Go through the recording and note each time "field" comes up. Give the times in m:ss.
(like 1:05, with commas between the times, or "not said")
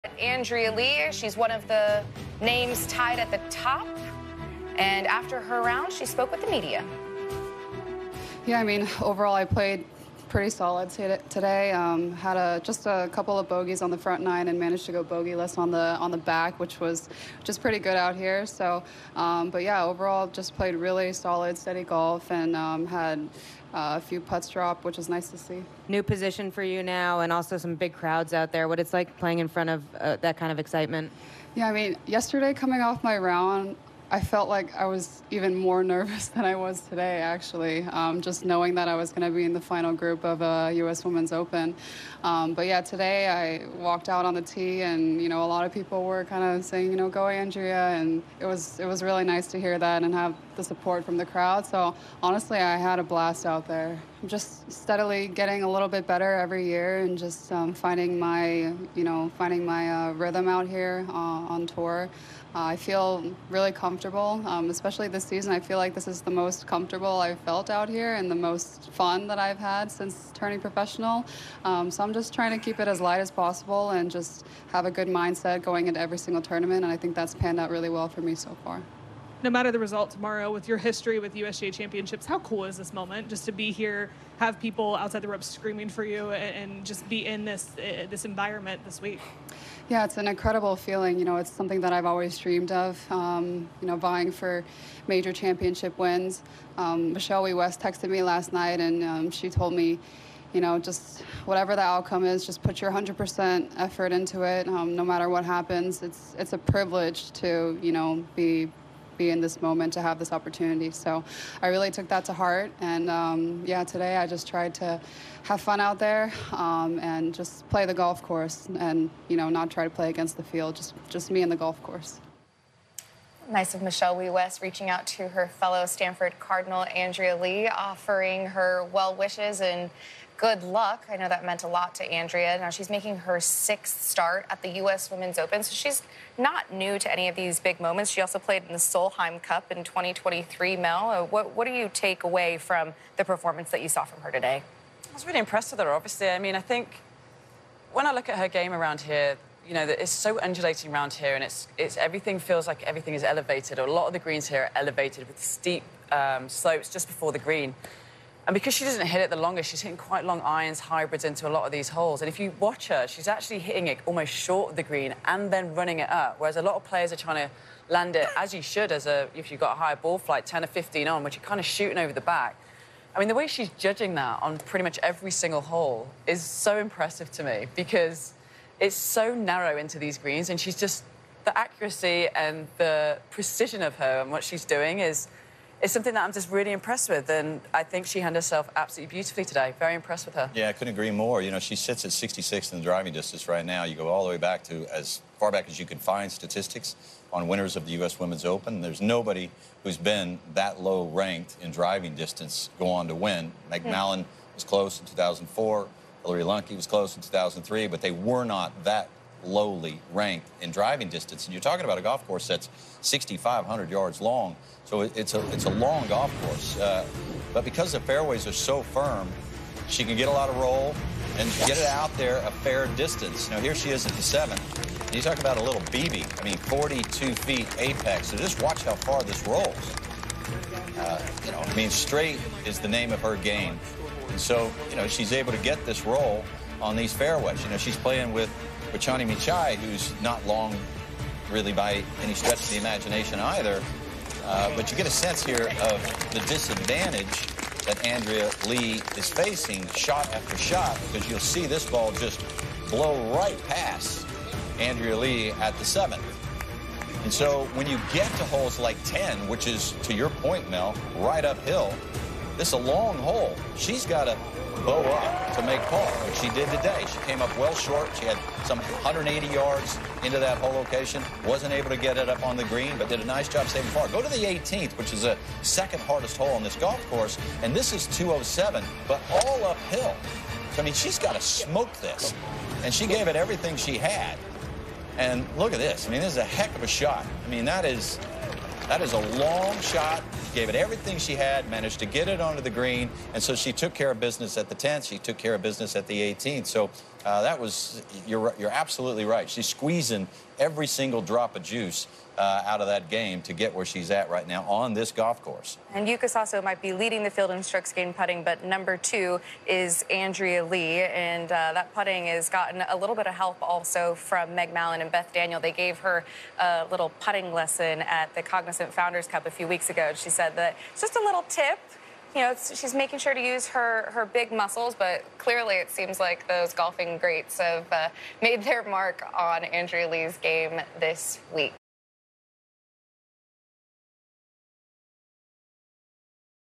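2:00, 5:07.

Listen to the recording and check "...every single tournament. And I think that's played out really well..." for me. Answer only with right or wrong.
wrong.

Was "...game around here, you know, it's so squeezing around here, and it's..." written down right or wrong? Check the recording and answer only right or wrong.
wrong.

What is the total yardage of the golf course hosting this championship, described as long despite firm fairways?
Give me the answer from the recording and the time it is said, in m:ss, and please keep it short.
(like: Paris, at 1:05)
6,500 yards, at 3:33.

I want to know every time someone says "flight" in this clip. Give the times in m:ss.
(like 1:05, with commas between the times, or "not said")
2:50.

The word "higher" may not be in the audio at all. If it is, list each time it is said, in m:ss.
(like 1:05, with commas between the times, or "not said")
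2:49.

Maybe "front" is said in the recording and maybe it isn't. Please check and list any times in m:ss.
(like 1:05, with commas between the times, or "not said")
0:13, 0:29.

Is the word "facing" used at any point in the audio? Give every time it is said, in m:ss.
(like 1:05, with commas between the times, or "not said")
4:09.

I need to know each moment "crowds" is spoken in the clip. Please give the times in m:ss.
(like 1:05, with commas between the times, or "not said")
0:27, 0:51.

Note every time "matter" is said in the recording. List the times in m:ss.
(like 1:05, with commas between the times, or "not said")
1:19, 1:45.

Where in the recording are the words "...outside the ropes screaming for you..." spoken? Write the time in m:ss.
1:24.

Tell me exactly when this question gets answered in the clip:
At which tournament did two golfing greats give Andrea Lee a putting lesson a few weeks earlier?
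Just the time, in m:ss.
5:18.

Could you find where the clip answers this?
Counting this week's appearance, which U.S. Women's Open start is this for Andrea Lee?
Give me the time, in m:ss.
2:13.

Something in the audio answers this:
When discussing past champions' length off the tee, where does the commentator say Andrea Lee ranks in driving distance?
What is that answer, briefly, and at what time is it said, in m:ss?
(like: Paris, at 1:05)
66, at 3:12.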